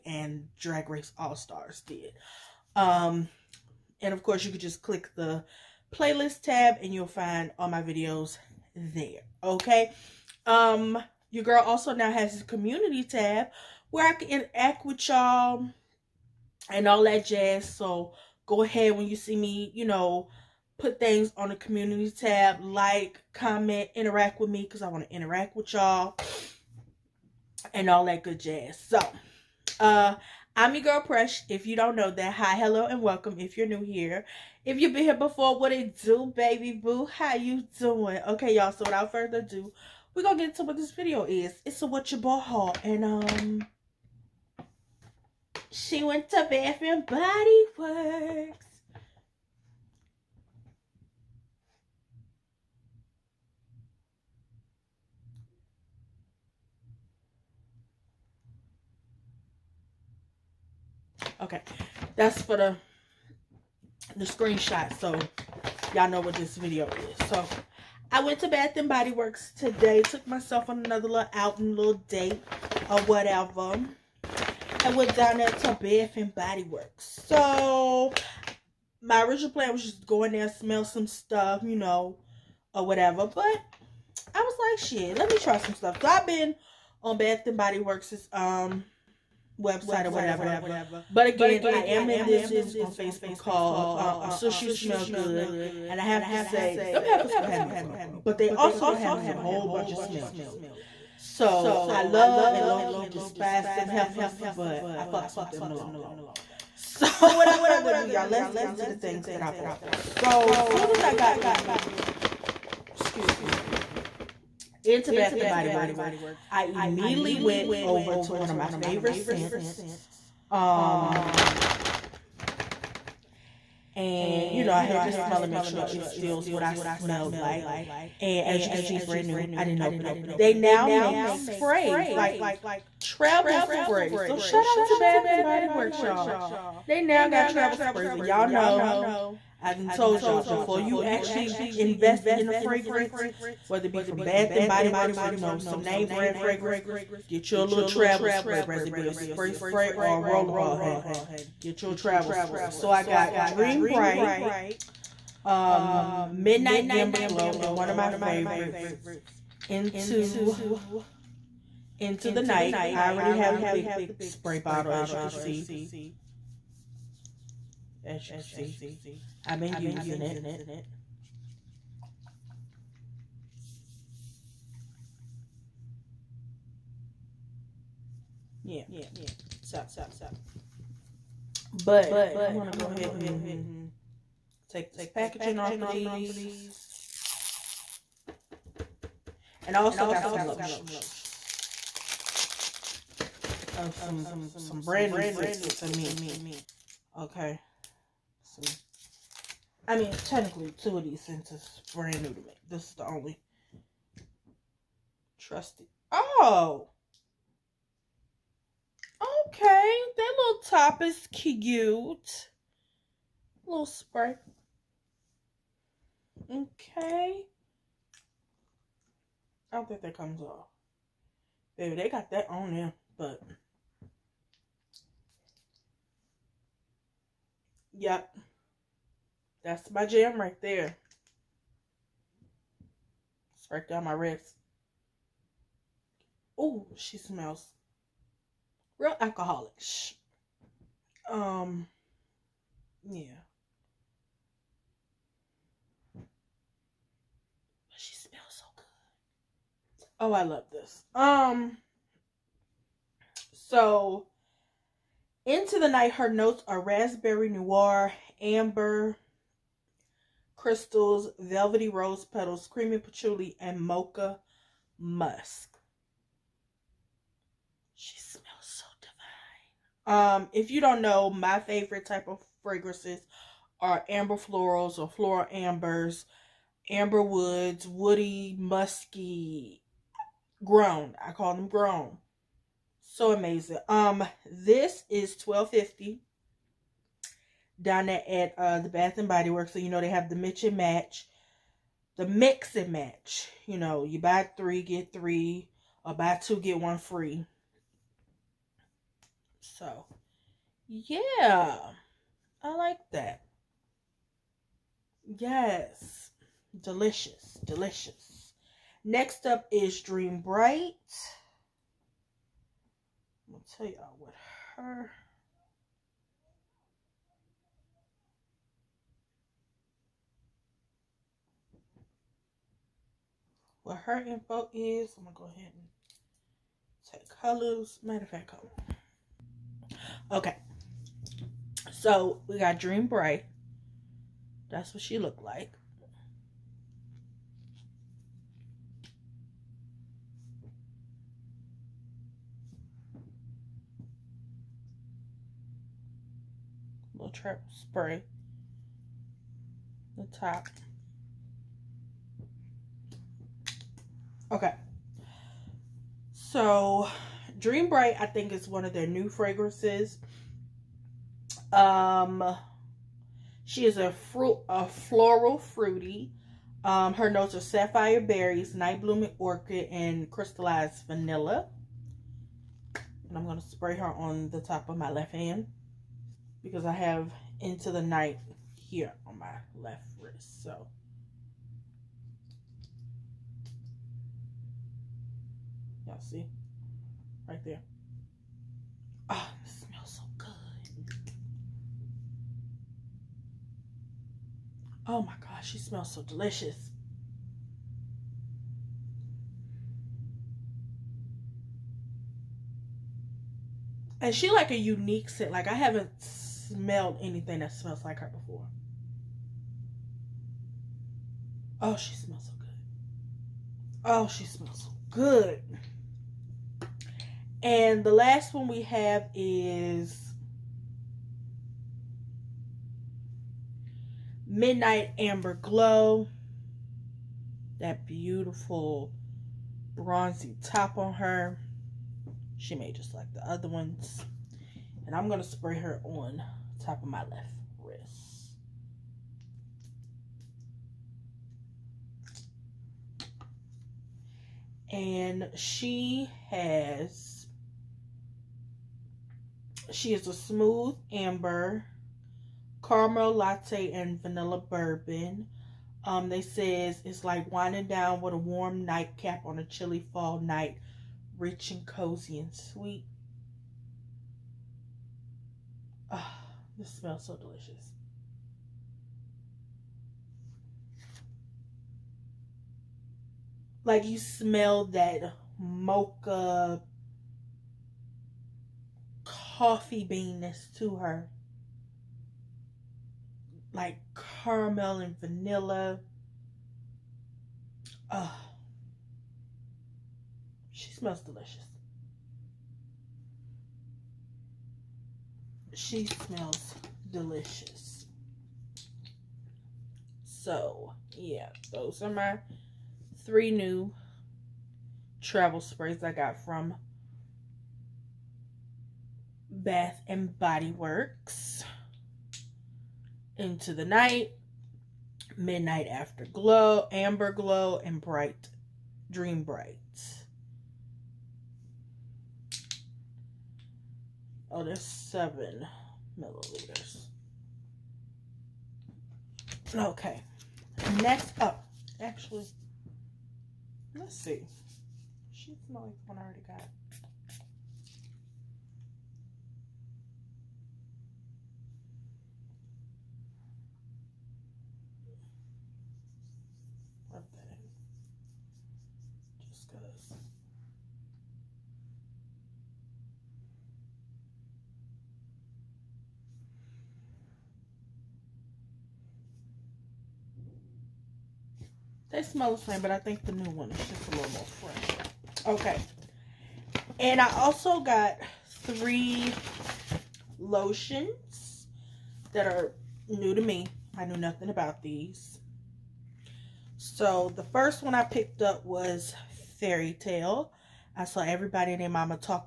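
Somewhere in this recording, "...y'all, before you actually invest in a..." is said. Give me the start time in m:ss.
2:20.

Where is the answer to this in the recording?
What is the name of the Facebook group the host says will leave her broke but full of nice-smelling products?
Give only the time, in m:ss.
1:34.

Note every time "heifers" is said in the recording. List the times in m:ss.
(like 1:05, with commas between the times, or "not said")
1:37, 1:43.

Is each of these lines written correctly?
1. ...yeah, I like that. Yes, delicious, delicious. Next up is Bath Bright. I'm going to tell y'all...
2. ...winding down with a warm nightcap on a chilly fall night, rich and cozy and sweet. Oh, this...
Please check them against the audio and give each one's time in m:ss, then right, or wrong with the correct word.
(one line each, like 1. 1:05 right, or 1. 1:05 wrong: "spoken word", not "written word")
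1. 5:00 wrong: "Dream", not "Bath"
2. 7:37 right.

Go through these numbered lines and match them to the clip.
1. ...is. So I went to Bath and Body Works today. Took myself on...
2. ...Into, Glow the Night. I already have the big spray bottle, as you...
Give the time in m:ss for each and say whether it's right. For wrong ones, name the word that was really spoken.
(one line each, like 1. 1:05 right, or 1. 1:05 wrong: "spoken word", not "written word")
1. 1:06 right
2. 2:39 wrong: "Into", not "Glow".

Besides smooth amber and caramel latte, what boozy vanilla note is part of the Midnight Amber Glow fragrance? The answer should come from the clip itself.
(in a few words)
vanilla bourbon.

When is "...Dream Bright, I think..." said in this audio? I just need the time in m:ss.
5:57.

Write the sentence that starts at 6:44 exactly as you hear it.
And she like a unique scent.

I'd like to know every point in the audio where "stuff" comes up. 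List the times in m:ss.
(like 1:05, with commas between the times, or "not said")
1:21, 1:25.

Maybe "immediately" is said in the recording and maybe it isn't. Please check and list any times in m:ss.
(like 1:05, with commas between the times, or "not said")
1:56.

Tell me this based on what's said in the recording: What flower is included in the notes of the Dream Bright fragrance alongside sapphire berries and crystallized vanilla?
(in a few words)
night blooming orchid.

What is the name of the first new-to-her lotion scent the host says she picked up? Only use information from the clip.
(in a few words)
Fairy Tale.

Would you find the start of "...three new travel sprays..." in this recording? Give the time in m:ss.
8:23.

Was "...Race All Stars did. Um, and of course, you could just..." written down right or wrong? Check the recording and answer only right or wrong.
right.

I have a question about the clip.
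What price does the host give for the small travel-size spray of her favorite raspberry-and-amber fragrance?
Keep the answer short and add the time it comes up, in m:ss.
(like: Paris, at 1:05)
12.50, at 4:45.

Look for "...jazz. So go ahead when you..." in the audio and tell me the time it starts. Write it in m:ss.
0:17.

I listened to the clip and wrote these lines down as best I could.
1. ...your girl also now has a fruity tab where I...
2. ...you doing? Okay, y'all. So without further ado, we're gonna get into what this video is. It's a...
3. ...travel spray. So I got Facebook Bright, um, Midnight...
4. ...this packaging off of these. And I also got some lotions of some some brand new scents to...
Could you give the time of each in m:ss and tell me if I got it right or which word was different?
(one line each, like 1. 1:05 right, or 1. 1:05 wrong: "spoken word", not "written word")
1. 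0:11 wrong: "community", not "fruity"
2. 0:37 right
3. 2:31 wrong: "Dream", not "Facebook"
4. 3:04 right.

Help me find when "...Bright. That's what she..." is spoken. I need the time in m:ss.
5:33.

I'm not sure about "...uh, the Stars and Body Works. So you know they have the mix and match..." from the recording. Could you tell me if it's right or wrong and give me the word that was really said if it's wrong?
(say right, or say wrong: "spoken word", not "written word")
wrong: "Bath", not "Stars".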